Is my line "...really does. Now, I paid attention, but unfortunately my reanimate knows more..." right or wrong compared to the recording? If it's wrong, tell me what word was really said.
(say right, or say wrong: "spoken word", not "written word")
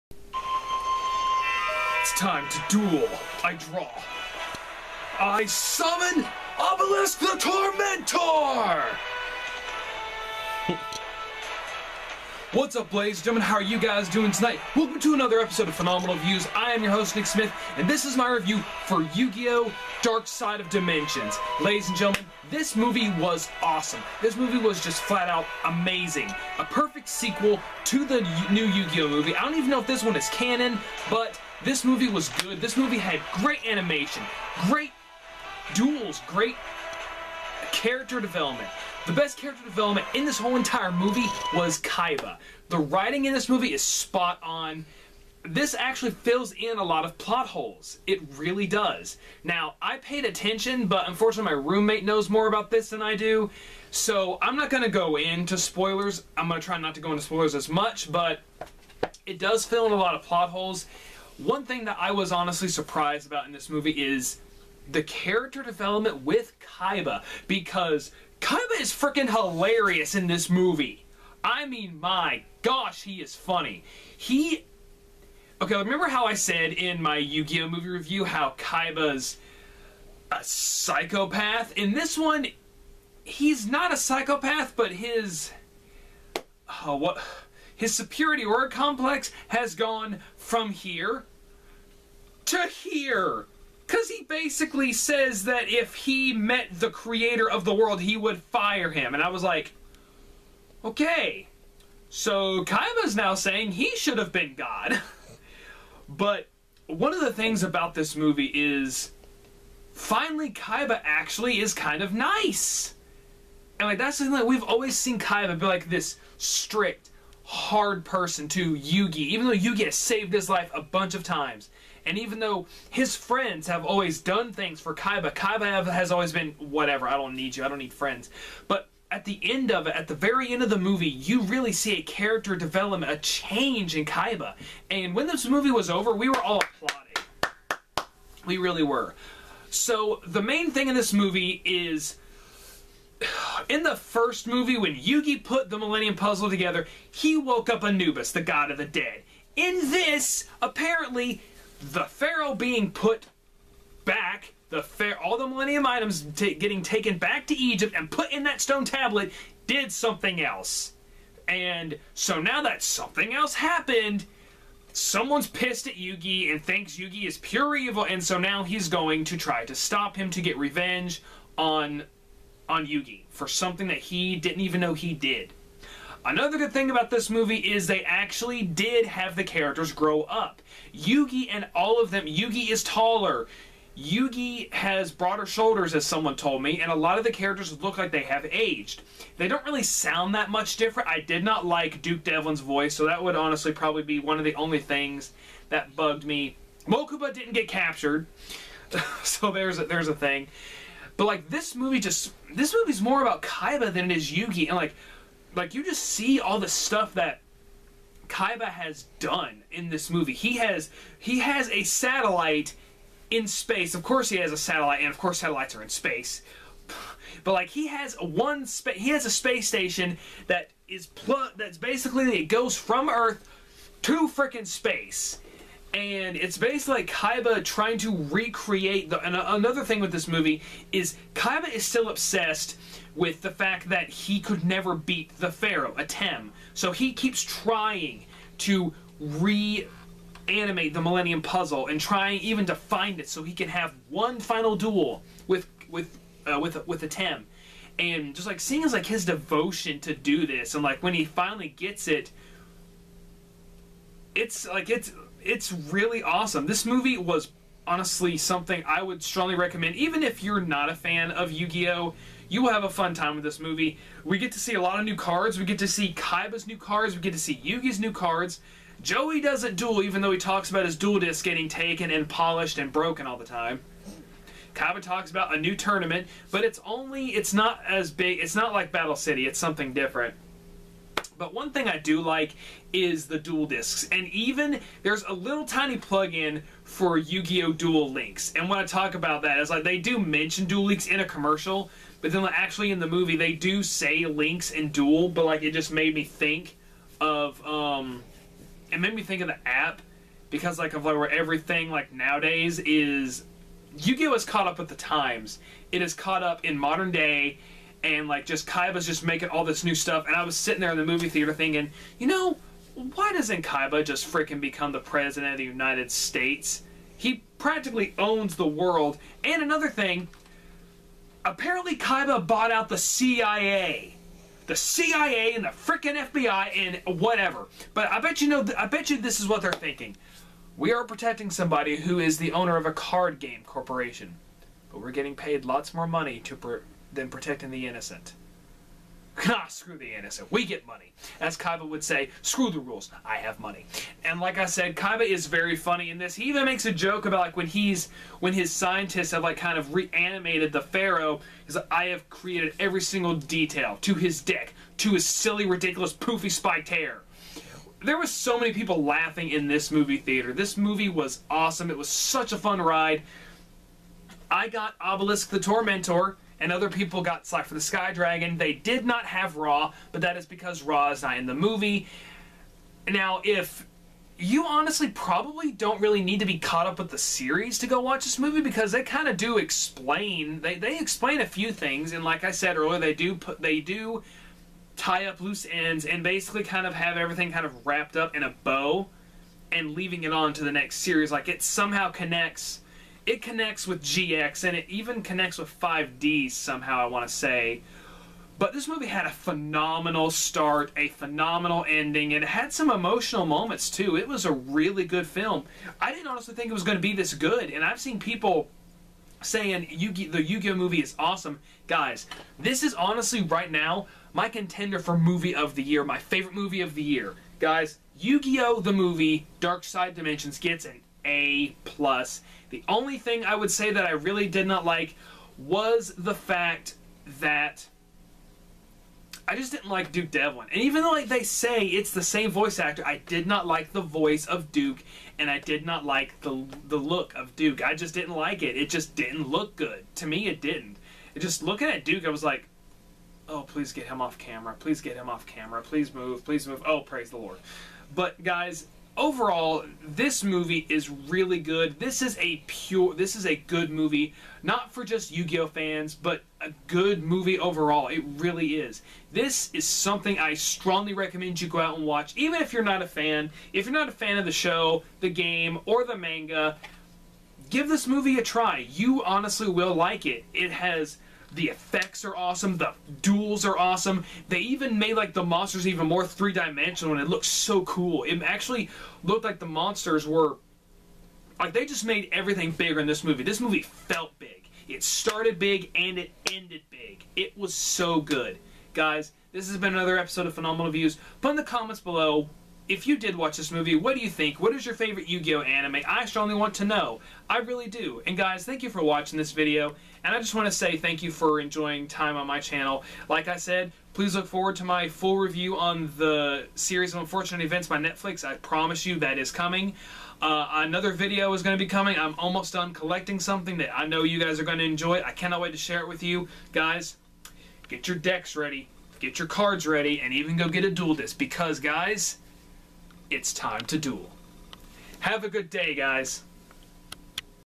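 wrong: "roommate", not "reanimate".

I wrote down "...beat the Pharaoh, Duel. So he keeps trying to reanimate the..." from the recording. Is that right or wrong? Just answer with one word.
wrong.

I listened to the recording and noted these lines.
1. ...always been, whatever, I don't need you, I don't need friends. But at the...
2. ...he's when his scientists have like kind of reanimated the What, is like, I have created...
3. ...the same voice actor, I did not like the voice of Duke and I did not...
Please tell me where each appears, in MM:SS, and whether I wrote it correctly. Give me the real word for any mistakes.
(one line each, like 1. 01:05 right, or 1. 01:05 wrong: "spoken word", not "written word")
1. 02:06 right
2. 05:47 wrong: "Pharaoh", not "What"
3. 07:12 right.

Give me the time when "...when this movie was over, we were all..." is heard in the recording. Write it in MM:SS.
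02:15.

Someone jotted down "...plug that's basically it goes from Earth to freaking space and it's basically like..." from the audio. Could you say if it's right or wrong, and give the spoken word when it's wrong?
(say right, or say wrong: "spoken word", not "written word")
right.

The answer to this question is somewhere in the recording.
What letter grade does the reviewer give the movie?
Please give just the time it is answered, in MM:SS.
07:00.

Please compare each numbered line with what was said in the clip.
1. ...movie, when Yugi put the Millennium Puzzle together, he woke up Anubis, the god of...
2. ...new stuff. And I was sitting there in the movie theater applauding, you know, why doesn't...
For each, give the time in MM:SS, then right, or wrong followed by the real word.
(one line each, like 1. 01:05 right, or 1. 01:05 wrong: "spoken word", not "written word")
1. 02:24 right
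2. 05:09 wrong: "thinking", not "applauding".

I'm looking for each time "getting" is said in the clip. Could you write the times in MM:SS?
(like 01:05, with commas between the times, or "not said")
02:36, 04:31, 05:35.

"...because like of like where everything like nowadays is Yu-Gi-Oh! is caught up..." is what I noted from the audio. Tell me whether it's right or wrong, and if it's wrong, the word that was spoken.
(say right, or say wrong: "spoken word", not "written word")
right.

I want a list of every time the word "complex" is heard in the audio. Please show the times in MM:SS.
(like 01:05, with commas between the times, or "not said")
01:28.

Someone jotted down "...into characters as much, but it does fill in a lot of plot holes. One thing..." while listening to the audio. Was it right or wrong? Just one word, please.
wrong.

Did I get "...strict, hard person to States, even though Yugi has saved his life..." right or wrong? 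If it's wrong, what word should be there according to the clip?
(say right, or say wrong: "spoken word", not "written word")
wrong: "Yugi", not "States".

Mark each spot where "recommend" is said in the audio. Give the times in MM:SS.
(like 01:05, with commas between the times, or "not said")
04:19, 07:41.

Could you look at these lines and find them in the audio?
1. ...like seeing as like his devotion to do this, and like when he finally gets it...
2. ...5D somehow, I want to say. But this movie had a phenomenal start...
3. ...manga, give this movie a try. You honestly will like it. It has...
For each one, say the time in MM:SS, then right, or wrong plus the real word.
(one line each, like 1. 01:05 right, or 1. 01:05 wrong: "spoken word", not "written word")
1. 04:08 right
2. 06:35 right
3. 07:46 right.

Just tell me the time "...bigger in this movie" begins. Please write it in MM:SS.
08:02.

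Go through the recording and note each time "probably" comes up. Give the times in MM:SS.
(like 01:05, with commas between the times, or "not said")
03:13, 06:15.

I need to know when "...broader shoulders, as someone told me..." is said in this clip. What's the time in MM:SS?
03:05.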